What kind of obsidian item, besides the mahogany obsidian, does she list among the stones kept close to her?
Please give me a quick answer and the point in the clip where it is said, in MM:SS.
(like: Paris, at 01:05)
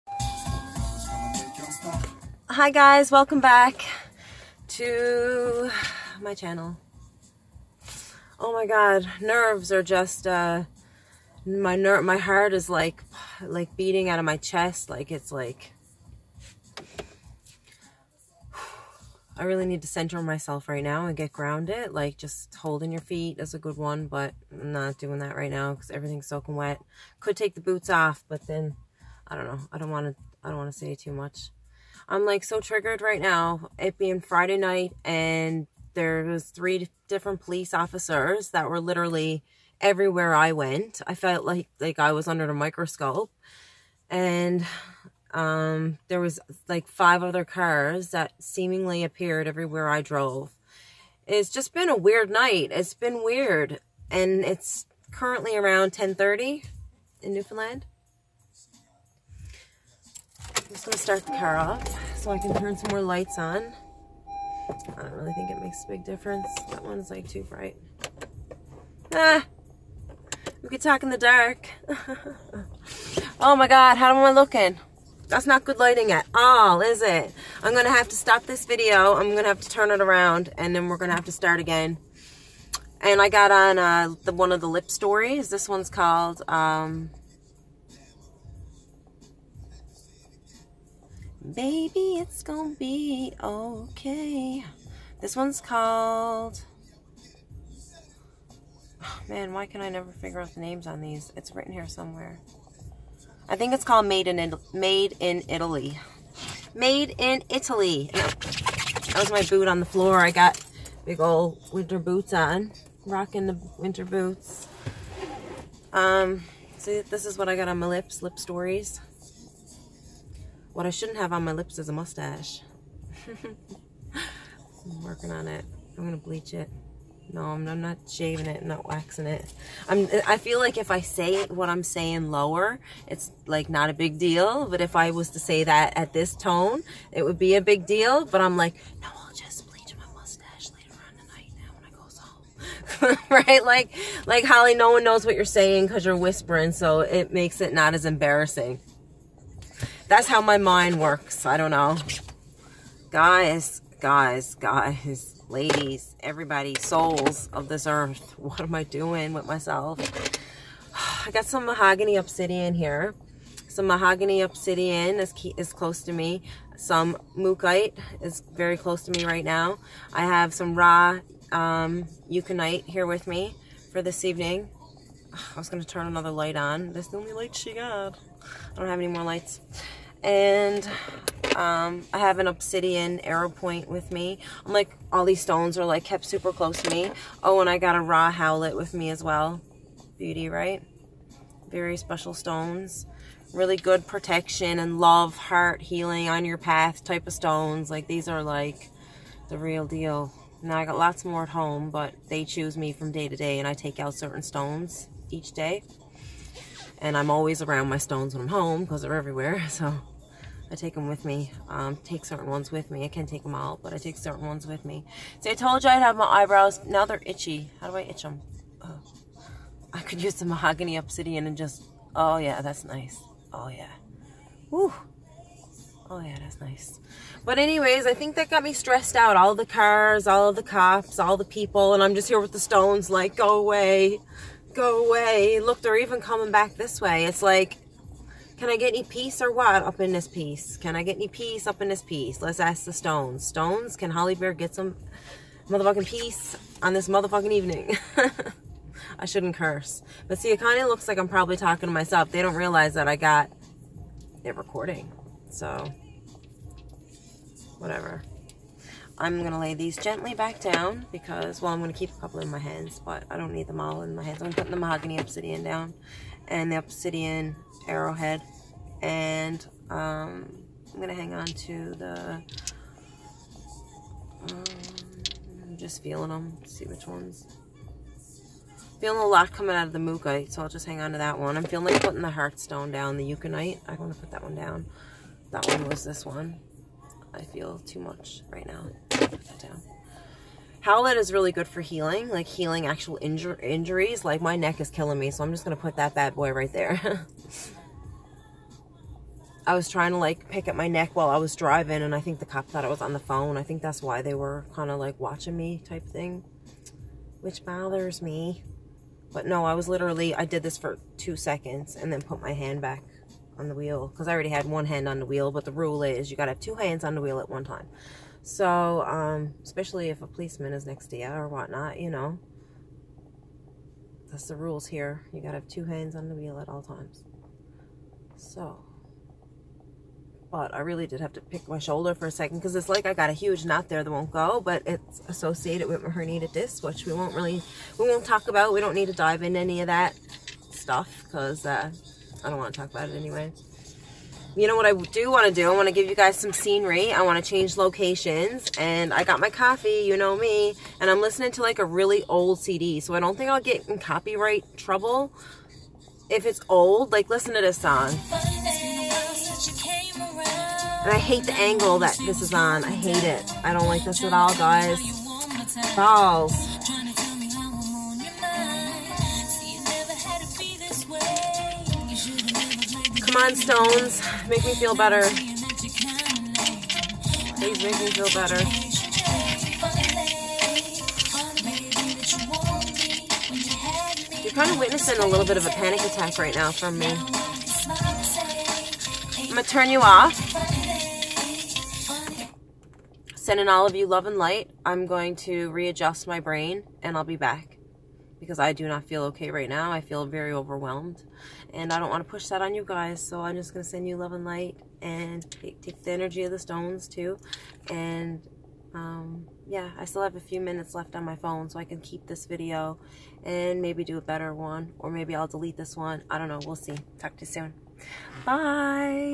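Obsidian arrow point, at 03:02.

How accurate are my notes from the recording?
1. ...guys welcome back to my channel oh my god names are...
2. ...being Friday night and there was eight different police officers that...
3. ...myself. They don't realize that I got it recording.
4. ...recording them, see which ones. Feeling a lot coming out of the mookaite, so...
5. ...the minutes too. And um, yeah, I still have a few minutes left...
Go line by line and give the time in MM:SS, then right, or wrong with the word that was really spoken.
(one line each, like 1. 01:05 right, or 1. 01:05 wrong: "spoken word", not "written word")
1. 00:02 wrong: "nerves", not "names"
2. 00:33 wrong: "three", not "eight"
3. 04:11 right
4. 04:36 wrong: "feeling", not "recording"
5. 06:46 wrong: "stones", not "minutes".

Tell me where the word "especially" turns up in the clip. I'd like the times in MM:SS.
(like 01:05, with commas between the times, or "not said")
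05:19.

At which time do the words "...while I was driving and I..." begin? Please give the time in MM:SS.
05:01.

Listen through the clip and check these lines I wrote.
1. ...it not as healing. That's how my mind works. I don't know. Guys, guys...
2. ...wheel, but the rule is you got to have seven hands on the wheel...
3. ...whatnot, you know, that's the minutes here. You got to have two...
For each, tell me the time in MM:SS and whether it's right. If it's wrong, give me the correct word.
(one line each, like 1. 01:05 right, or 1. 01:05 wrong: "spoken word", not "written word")
1. 02:27 wrong: "embarrassing", not "healing"
2. 05:15 wrong: "two", not "seven"
3. 05:21 wrong: "rules", not "minutes".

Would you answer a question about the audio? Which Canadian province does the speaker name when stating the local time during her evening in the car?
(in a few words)
Newfoundland.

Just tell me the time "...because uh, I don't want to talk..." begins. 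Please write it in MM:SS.
05:41.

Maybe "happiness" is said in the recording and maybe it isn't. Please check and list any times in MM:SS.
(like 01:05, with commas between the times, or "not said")
not said.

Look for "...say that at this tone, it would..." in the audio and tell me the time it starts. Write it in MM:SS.
02:15.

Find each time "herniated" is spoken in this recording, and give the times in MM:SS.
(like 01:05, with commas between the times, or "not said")
05:36.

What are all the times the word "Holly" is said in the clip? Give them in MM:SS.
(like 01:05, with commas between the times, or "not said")
02:24, 04:04.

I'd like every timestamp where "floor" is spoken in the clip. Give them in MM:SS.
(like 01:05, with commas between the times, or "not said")
01:49.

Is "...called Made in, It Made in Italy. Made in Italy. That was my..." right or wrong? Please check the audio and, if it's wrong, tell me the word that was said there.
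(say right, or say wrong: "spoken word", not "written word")
right.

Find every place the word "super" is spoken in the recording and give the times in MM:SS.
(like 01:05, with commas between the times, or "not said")
03:06.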